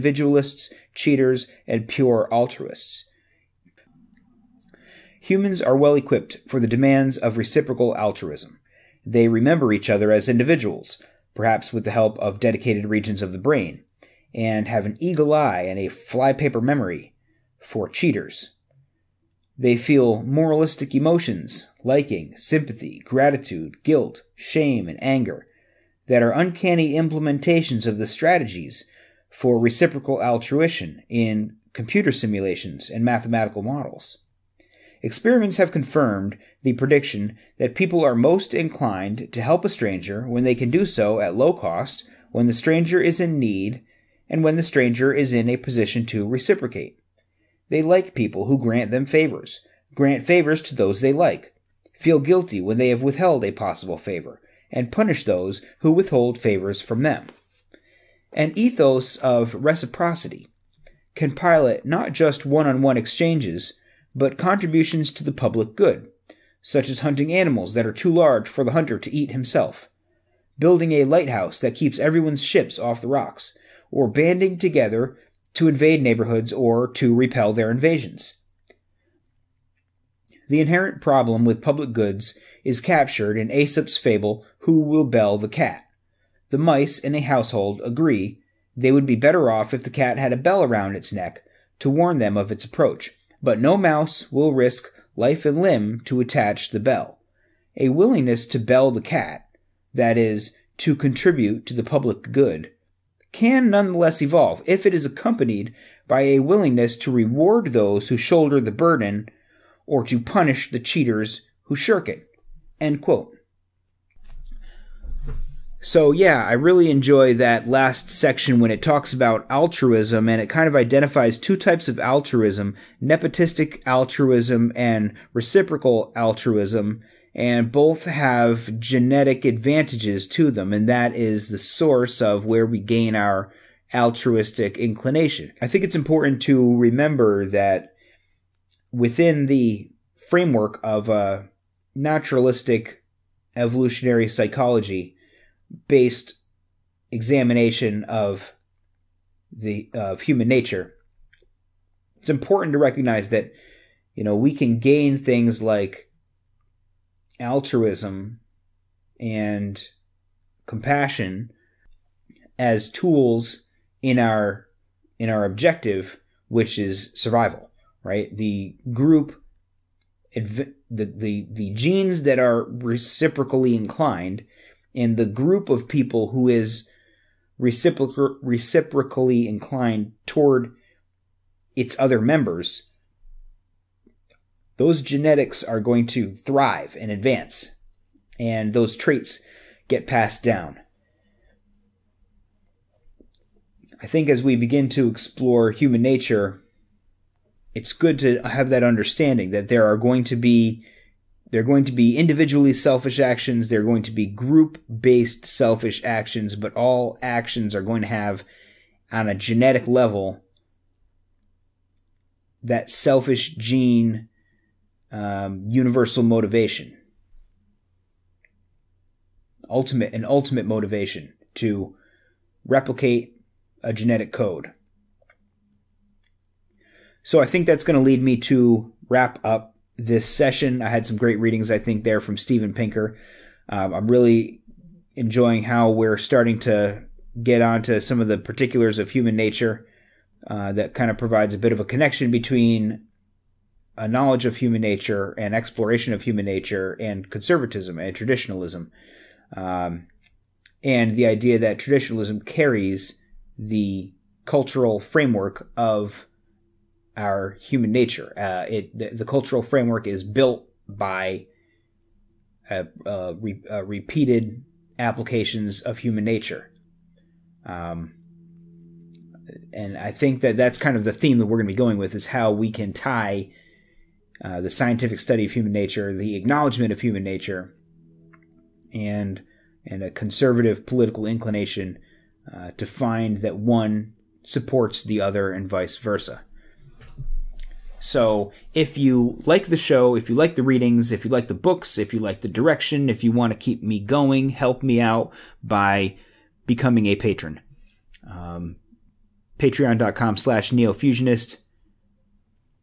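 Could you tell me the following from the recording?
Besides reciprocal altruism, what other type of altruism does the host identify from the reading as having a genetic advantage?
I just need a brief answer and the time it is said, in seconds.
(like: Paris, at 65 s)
Nepotistic altruism, at 123 s.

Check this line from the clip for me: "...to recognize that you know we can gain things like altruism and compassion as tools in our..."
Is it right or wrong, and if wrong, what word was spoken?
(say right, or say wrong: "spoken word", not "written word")
right.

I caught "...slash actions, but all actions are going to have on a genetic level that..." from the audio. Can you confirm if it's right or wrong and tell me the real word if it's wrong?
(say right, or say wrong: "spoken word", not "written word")
wrong: "selfish", not "slash".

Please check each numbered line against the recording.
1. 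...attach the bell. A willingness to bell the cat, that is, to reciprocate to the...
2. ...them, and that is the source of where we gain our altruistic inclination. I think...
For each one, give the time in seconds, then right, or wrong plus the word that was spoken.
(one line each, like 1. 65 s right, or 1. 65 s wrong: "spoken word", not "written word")
1. 96 s wrong: "contribute", not "reciprocate"
2. 130 s right.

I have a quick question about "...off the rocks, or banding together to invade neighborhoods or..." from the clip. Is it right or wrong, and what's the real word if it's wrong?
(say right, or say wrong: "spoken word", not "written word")
right.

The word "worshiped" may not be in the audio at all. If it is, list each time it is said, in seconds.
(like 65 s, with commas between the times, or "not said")
not said.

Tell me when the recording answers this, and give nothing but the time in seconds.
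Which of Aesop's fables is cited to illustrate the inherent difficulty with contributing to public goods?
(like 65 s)
84 s.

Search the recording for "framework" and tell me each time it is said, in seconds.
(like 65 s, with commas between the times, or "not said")
140 s, 254 s, 259 s.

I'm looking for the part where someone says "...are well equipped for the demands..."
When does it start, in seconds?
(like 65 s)
5 s.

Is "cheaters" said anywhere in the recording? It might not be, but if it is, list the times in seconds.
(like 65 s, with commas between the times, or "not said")
0 s, 17 s, 110 s.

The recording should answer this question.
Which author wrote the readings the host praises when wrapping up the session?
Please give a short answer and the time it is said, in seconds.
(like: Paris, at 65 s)
Steven Pinker, at 232 s.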